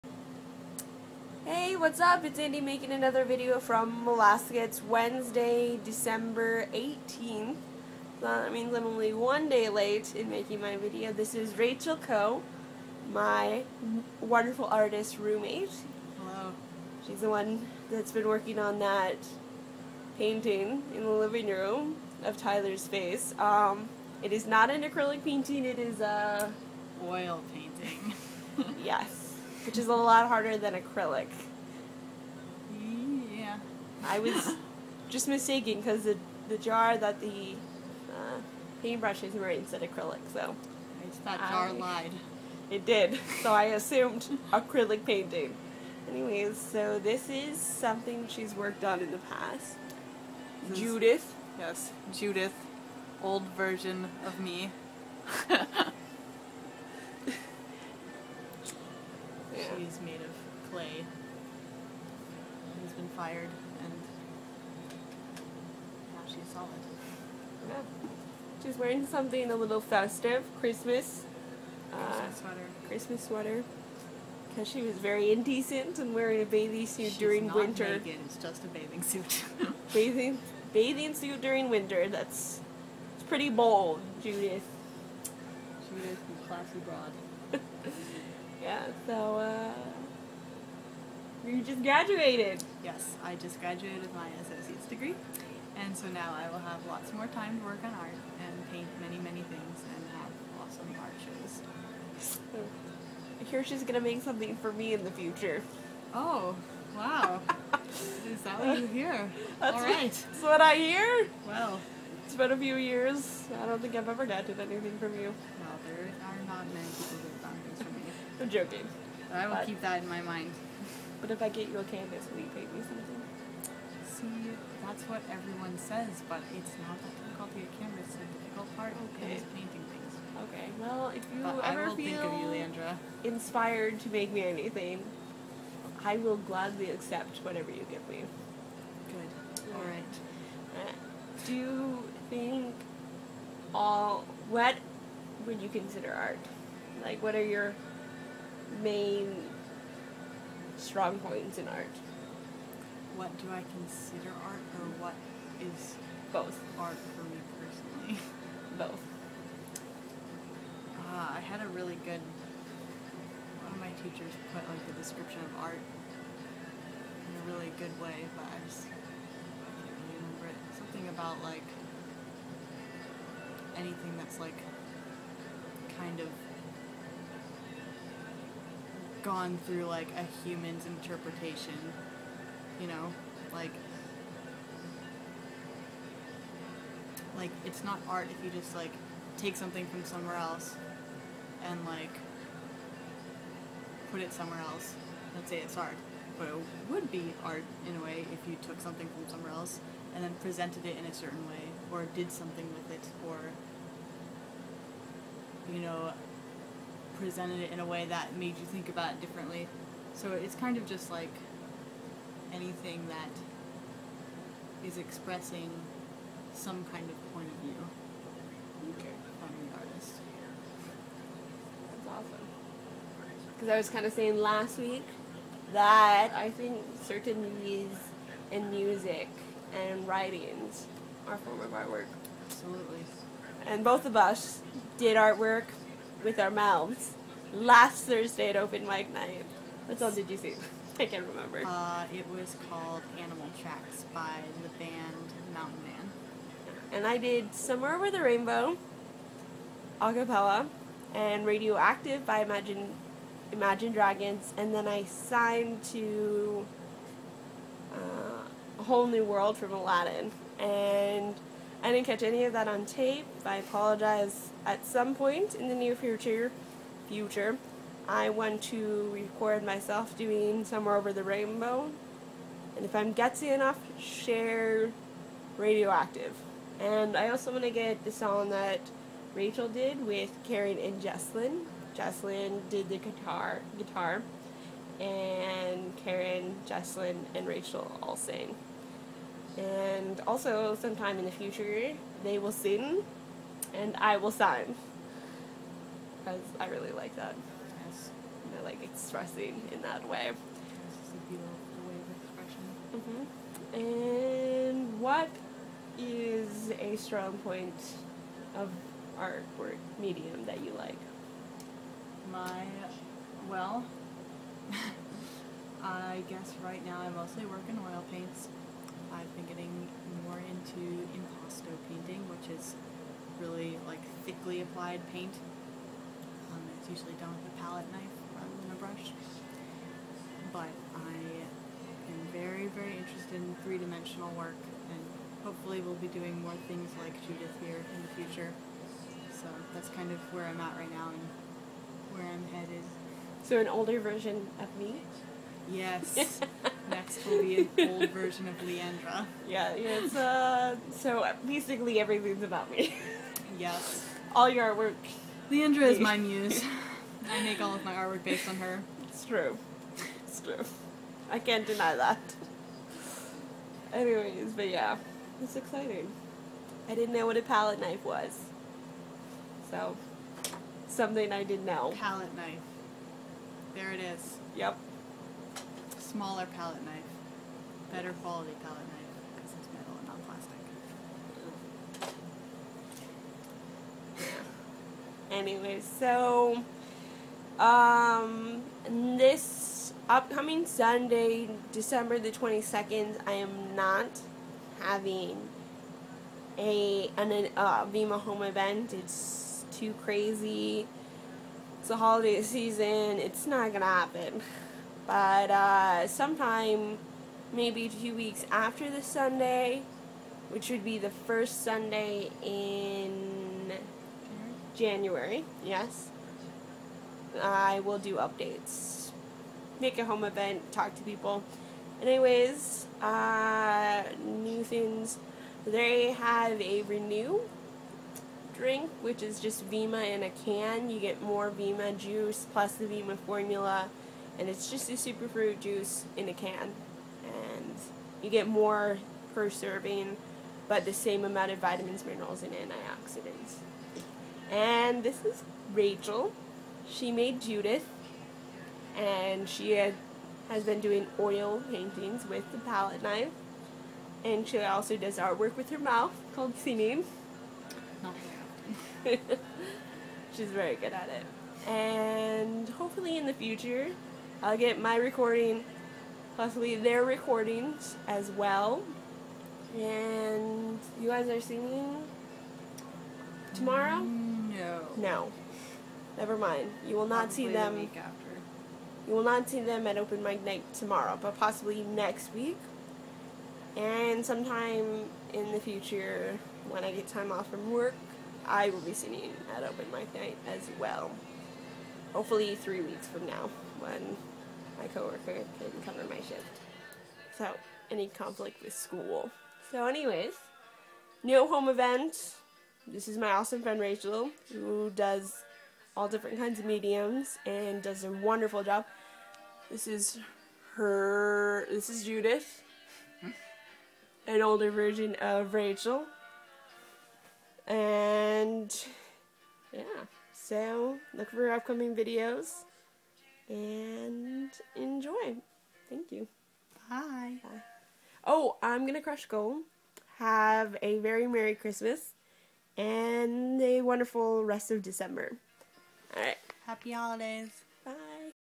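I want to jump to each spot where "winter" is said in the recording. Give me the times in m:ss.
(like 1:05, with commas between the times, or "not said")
1:17, 1:21.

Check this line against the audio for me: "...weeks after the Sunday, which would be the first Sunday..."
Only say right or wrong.
right.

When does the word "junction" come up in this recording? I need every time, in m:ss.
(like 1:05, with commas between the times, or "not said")
not said.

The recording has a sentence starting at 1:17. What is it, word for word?
Naked, it's just a bathing suit.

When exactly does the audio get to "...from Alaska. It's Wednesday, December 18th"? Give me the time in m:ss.
0:03.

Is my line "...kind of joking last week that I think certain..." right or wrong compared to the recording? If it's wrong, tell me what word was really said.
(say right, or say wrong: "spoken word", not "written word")
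wrong: "saying", not "joking".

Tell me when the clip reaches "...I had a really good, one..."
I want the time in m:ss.
2:41.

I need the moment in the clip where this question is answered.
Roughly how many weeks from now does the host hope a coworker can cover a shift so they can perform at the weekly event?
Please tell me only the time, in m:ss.
8:12.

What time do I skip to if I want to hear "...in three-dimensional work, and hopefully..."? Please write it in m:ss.
5:33.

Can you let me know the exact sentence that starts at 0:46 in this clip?
Anyways, so this is something she's worked on in the past.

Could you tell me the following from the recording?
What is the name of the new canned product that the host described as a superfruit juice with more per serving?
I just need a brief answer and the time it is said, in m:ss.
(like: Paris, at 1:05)
Renew, at 7:06.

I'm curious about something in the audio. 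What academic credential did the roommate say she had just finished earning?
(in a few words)
Associate's degree.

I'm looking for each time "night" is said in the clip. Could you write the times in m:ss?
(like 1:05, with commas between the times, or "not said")
3:59, 8:00, 8:10.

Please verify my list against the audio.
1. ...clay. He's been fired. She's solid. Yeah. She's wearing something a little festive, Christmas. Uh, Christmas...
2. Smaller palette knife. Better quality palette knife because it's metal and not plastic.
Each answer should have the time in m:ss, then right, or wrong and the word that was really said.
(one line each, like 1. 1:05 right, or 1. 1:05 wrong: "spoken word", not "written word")
1. 1:00 right
2. 6:15 right.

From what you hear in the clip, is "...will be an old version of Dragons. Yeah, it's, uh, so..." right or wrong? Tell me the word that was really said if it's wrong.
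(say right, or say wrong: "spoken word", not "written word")
wrong: "Leandra", not "Dragons".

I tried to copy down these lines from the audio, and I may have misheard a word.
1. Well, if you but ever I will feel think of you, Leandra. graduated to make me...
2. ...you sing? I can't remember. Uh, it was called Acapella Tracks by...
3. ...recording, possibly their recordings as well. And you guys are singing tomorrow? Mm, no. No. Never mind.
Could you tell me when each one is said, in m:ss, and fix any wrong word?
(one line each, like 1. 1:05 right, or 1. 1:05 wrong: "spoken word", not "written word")
1. 2:10 wrong: "inspired", not "graduated"
2. 4:00 wrong: "Animal", not "Acapella"
3. 7:44 right.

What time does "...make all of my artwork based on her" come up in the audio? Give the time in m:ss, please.
5:57.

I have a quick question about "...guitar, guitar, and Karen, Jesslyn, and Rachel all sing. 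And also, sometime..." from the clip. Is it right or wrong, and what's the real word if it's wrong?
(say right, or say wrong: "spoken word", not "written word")
right.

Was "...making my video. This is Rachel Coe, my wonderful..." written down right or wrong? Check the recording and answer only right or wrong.
right.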